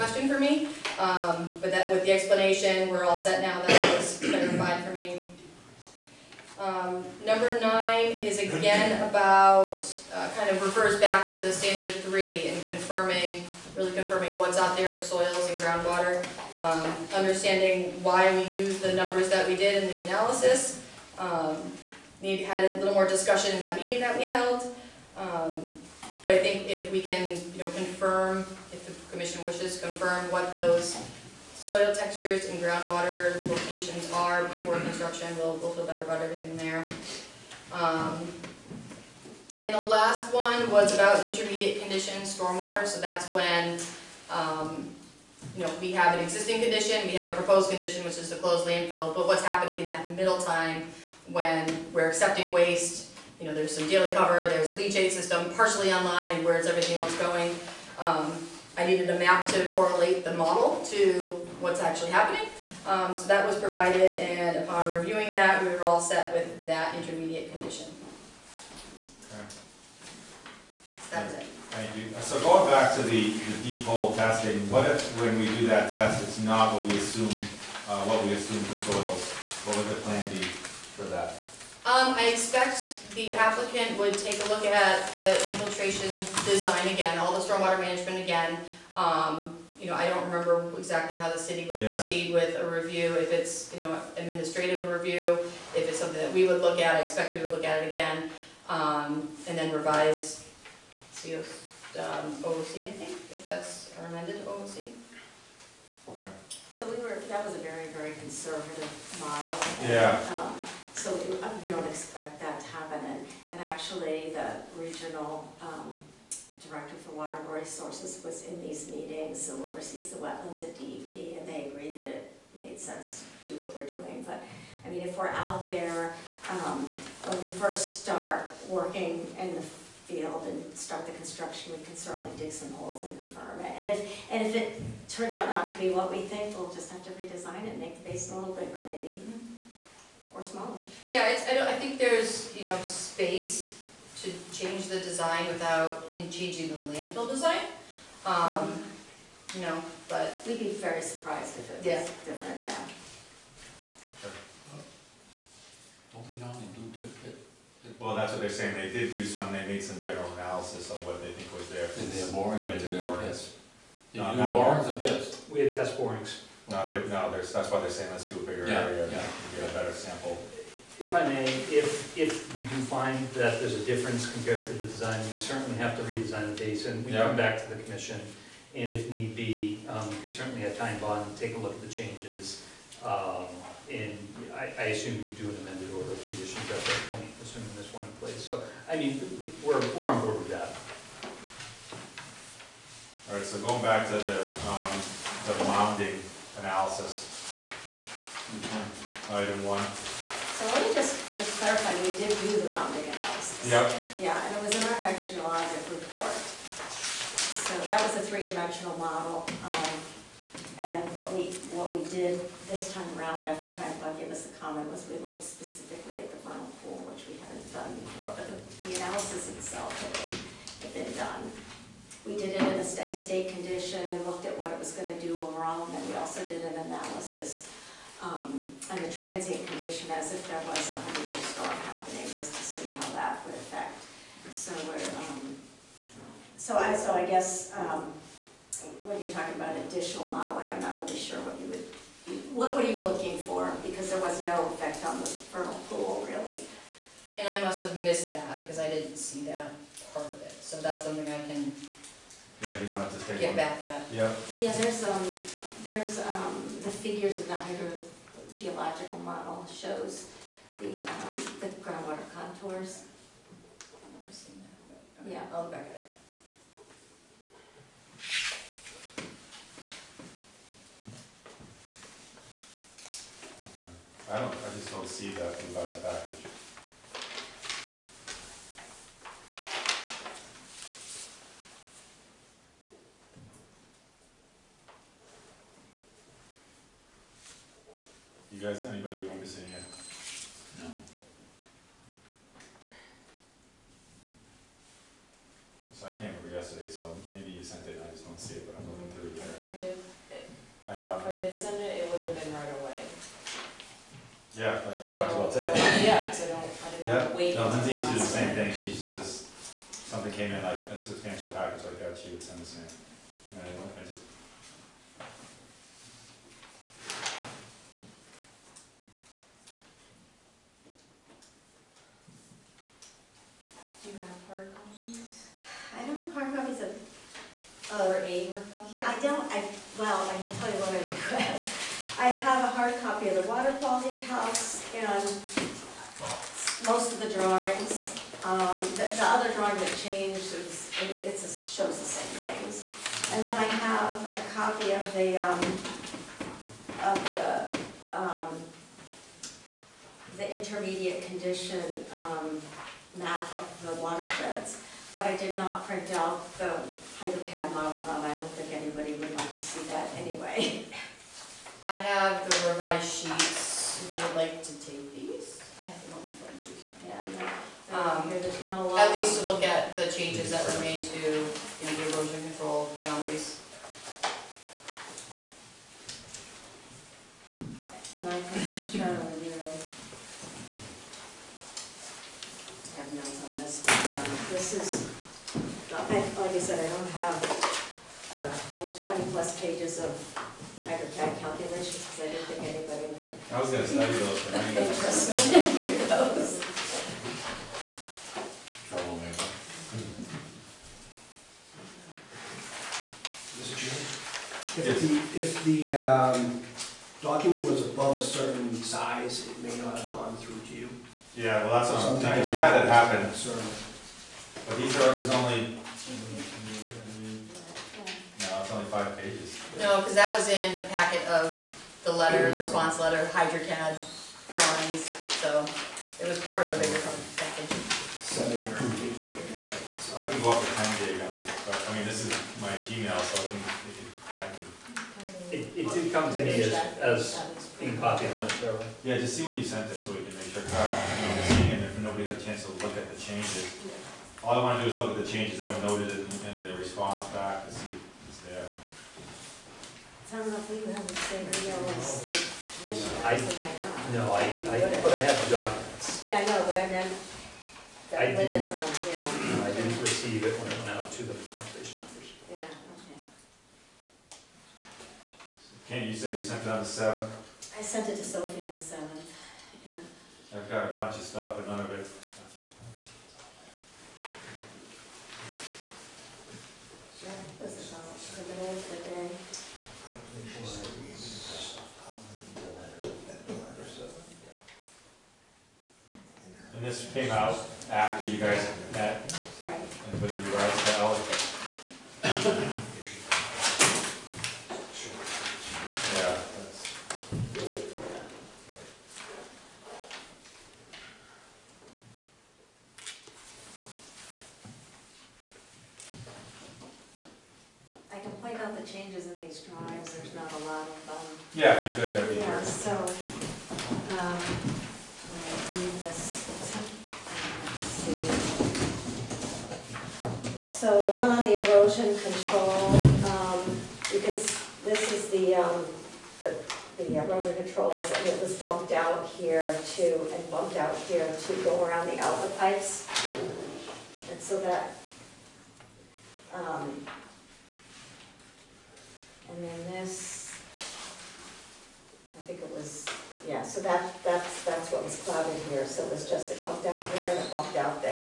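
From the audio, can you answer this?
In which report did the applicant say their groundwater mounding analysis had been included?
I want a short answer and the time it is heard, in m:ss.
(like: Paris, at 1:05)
hydrogeologic report, at 3:25.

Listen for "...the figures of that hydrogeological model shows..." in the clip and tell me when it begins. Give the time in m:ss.
4:16.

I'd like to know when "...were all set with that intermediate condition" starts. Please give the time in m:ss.
1:05.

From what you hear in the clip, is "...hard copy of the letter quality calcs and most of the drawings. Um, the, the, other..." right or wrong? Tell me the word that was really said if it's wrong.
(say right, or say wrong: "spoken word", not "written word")
wrong: "water", not "letter".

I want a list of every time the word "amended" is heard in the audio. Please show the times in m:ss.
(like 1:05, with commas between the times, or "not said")
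1:44, 3:05.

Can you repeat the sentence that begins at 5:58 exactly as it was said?
I don't think anybody would like to see that anyway.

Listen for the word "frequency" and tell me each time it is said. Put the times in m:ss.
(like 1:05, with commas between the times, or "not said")
not said.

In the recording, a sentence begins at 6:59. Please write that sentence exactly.
No, because that was in the packet of the letter, response letter, HydroCAD drawings, so it was part of a bigger package.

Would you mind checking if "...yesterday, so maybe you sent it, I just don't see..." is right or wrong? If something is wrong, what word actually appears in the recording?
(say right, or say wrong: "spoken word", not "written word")
right.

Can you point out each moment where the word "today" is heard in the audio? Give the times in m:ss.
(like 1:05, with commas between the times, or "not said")
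5:05.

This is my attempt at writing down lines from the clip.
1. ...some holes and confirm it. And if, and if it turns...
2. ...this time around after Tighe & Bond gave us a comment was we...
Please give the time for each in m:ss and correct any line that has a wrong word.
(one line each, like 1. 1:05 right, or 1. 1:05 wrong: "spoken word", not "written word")
1. 2:12 right
2. 3:32 right.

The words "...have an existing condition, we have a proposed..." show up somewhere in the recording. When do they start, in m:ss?
0:45.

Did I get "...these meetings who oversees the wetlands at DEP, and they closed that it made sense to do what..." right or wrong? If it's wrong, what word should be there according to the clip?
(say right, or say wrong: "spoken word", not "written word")
wrong: "agreed", not "closed".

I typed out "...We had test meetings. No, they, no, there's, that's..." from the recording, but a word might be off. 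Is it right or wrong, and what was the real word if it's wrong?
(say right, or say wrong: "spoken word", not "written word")
wrong: "borings", not "meetings".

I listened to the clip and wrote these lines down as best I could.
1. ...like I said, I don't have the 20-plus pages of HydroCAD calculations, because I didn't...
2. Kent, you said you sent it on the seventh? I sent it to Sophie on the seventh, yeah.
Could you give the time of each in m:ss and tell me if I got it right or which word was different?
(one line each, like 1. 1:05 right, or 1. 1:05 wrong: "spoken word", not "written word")
1. 6:26 right
2. 7:45 right.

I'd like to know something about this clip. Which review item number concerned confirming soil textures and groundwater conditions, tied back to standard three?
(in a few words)
9.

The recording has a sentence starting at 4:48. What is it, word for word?
You guys, anybody you want to say yet?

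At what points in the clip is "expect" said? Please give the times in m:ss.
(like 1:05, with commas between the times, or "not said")
1:22, 1:37, 1:51.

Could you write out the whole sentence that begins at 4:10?
So that's something I can yeah, you want to take Get one?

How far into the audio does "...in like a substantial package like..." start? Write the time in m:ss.
5:10.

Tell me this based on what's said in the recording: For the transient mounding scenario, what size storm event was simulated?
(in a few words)
hundred-year storm.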